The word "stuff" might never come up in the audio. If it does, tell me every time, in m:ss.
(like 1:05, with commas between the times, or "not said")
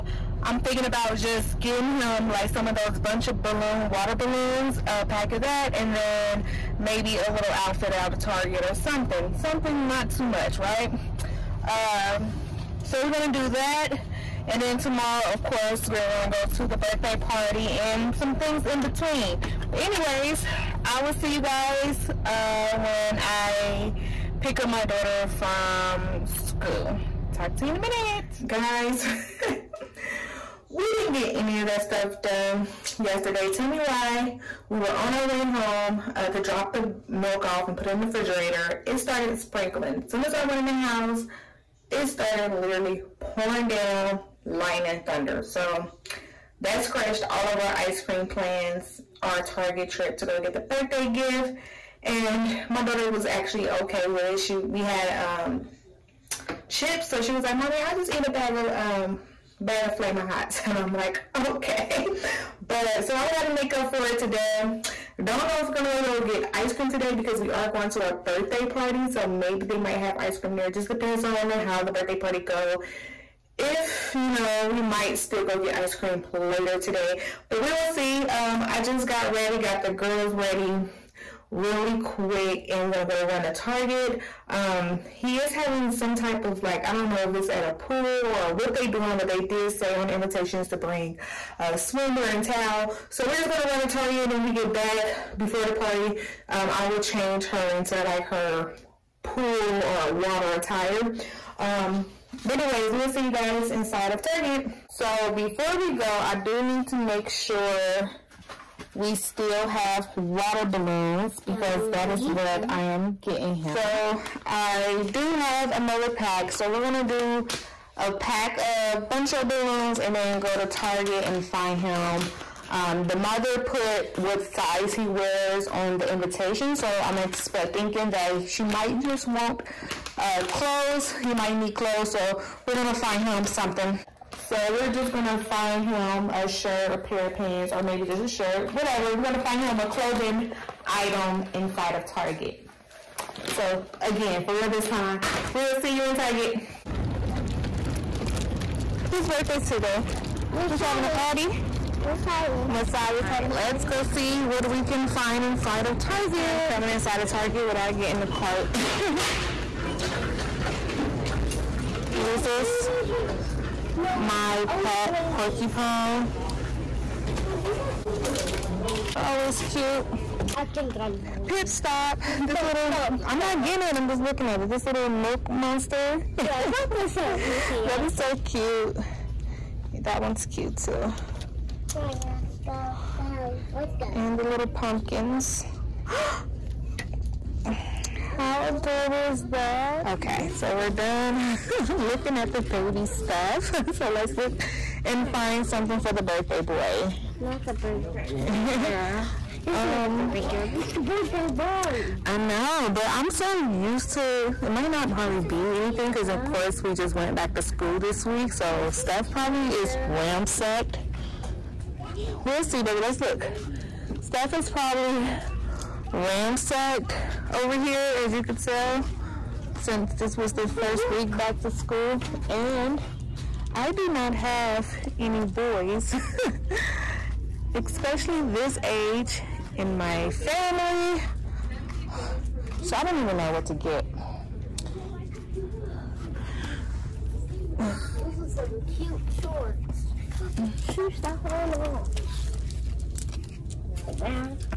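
0:31, 3:13, 3:28, 3:34.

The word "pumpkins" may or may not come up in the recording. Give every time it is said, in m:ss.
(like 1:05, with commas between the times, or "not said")
3:04.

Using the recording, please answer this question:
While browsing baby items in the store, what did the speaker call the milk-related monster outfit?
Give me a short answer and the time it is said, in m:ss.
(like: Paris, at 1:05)
milk monster, at 2:55.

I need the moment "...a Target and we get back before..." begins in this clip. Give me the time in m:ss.
1:33.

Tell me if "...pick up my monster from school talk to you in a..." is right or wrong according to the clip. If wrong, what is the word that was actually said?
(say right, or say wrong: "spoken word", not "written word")
wrong: "daughter", not "monster".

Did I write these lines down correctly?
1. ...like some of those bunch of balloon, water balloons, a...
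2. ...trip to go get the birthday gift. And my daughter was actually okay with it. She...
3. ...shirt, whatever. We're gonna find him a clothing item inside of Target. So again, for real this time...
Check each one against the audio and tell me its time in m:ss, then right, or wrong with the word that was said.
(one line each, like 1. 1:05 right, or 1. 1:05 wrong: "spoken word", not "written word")
1. 0:02 right
2. 0:49 right
3. 2:18 right.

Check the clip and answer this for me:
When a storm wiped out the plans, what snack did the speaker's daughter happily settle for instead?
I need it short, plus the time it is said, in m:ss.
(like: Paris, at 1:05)
Flamin' Hots, at 0:59.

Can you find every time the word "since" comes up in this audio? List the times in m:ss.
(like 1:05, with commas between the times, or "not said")
3:39.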